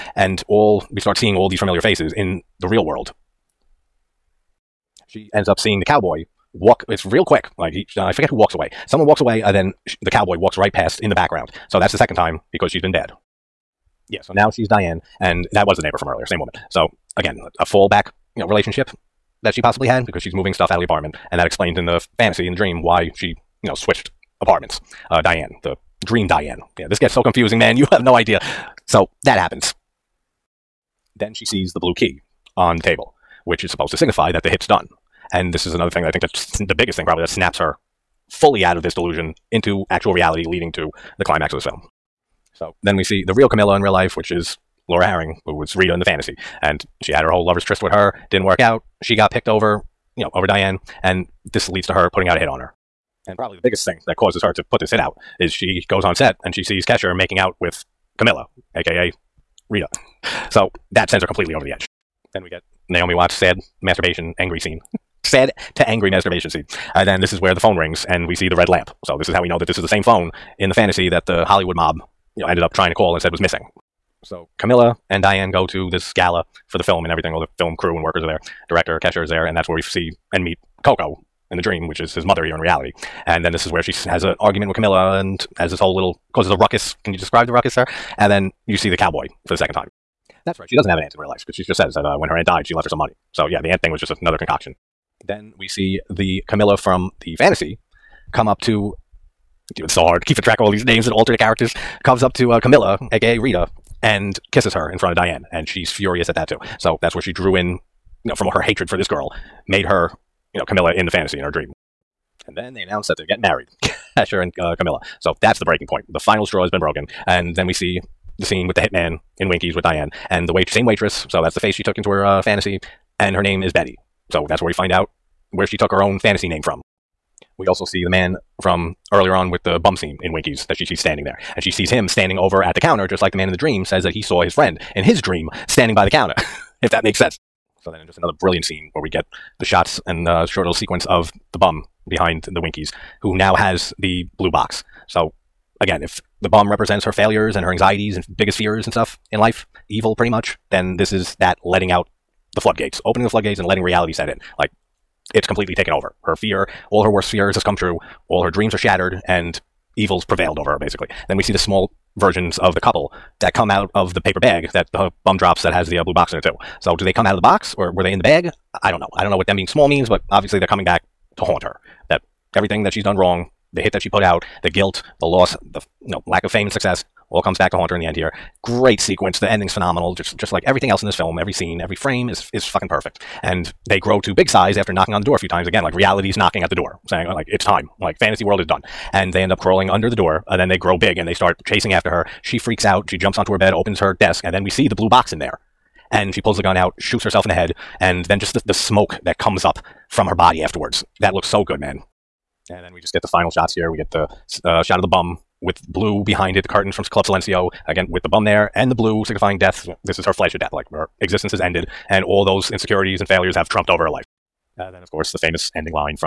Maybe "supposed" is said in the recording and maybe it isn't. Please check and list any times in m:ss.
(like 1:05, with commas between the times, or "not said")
0:33.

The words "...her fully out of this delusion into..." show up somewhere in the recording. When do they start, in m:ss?
0:37.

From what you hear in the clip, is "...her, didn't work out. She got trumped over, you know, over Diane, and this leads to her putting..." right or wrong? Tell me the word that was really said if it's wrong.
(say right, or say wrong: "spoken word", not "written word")
wrong: "picked", not "trumped".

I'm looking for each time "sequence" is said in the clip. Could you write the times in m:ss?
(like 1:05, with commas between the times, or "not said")
2:20, 2:58.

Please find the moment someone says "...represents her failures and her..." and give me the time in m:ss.
2:26.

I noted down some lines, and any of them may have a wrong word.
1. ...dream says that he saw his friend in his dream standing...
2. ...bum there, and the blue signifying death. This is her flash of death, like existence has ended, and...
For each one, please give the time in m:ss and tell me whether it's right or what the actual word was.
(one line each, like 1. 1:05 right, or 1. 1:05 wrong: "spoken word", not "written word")
1. 2:13 right
2. 3:28 right.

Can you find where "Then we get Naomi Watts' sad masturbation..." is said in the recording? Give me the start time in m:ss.
1:02.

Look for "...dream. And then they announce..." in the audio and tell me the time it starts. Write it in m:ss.
1:51.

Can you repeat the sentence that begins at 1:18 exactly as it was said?
Director Kesher is there, and that's where we see and meet Coco, in the dream, which is his mother here in reality.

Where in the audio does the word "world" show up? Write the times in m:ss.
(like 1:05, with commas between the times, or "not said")
0:02, 3:08.